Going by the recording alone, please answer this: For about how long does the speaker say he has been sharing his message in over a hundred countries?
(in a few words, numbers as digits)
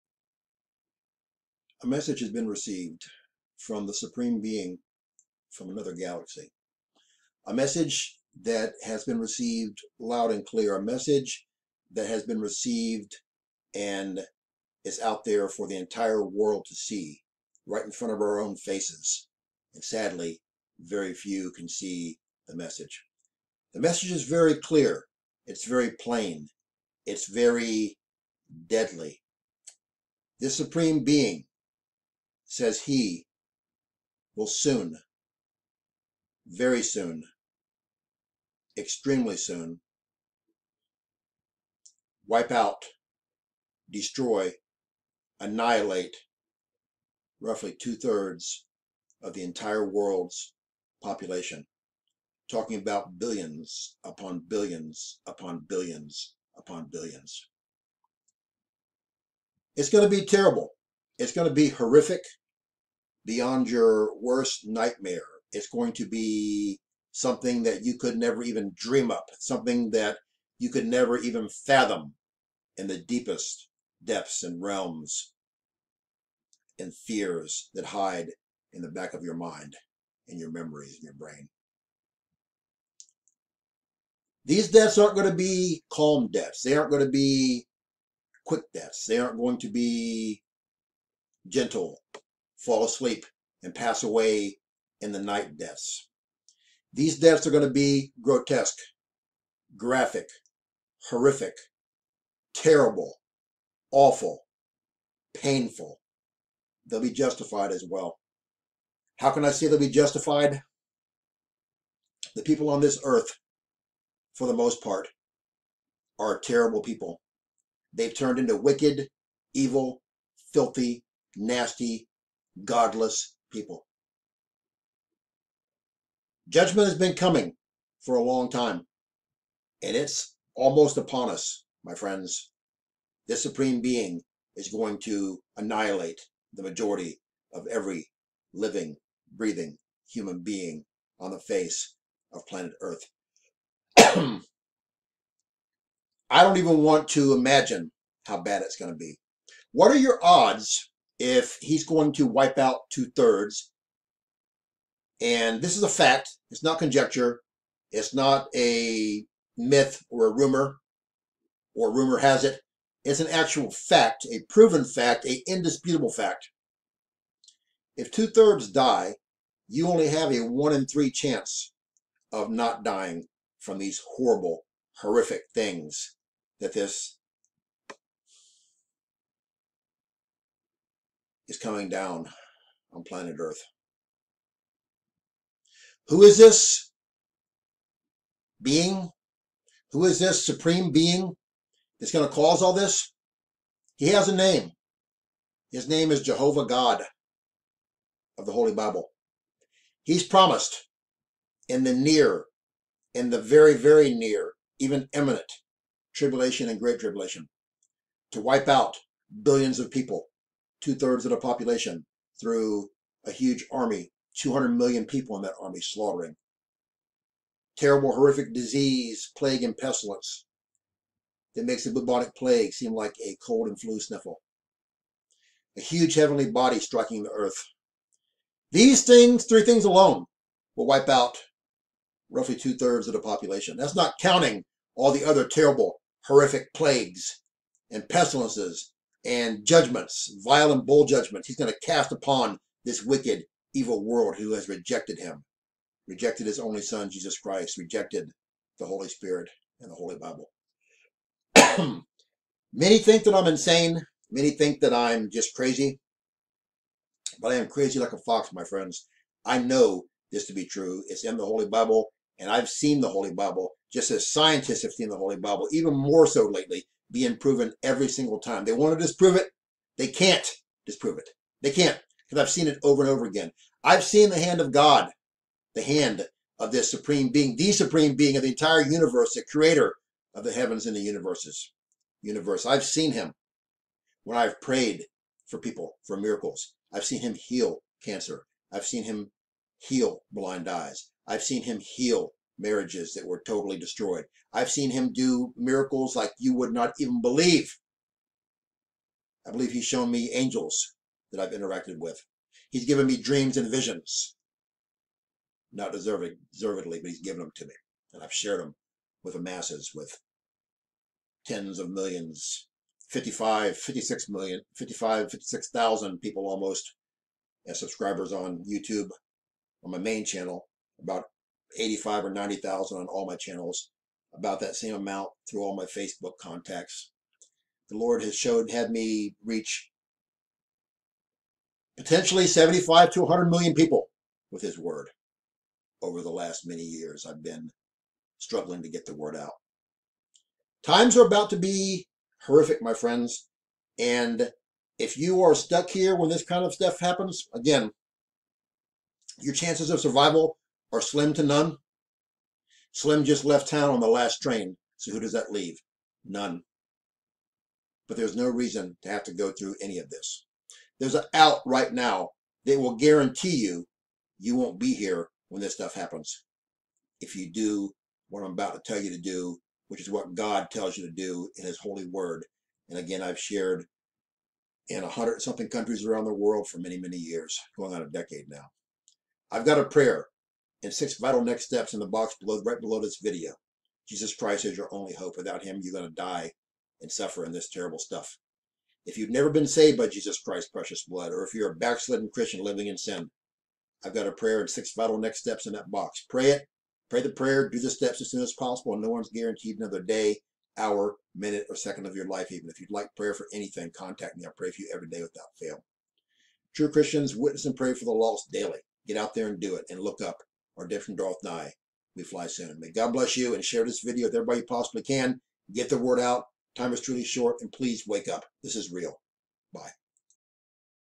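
a decade.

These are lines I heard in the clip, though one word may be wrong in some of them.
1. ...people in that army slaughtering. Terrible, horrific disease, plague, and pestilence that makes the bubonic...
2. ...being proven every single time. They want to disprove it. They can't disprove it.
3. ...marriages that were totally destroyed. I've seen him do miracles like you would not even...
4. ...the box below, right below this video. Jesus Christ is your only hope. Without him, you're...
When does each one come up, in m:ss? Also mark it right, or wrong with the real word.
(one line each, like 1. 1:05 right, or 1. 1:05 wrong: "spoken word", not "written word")
1. 3:35 right
2. 4:27 right
3. 4:52 right
4. 6:21 right.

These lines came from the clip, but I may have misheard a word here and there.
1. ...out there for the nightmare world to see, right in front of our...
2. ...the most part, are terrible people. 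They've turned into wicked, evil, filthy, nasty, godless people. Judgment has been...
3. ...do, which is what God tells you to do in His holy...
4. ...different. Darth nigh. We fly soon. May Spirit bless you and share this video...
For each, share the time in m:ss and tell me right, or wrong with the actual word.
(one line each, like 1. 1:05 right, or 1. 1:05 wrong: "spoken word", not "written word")
1. 0:14 wrong: "entire", not "nightmare"
2. 1:54 right
3. 6:09 right
4. 6:50 wrong: "God", not "Spirit".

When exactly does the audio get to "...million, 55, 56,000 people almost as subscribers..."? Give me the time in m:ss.
5:14.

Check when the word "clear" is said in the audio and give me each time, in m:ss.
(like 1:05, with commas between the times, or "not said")
0:10, 0:24.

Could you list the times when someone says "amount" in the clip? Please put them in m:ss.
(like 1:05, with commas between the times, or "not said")
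5:24.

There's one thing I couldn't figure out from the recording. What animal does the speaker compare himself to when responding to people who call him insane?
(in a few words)
fox.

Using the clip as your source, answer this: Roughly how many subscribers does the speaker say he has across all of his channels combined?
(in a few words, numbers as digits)
85 or 90,000.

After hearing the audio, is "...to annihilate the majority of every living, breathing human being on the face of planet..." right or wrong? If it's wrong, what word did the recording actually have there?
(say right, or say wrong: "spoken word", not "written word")
right.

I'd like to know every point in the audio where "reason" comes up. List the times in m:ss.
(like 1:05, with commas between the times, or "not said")
5:58.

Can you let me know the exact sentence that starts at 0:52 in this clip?
Talking about billions upon billions upon billions upon billions.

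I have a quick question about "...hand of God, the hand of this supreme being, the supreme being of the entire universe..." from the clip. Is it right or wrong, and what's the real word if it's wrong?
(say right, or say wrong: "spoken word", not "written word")
right.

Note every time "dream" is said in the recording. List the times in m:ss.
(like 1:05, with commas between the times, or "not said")
1:08, 5:03.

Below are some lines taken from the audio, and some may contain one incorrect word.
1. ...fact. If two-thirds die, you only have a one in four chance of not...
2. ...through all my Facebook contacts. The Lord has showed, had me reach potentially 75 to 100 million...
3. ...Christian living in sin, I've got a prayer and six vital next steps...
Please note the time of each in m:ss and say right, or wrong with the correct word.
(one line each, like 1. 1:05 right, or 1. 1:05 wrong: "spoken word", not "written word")
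1. 2:46 wrong: "three", not "four"
2. 5:25 right
3. 6:32 right.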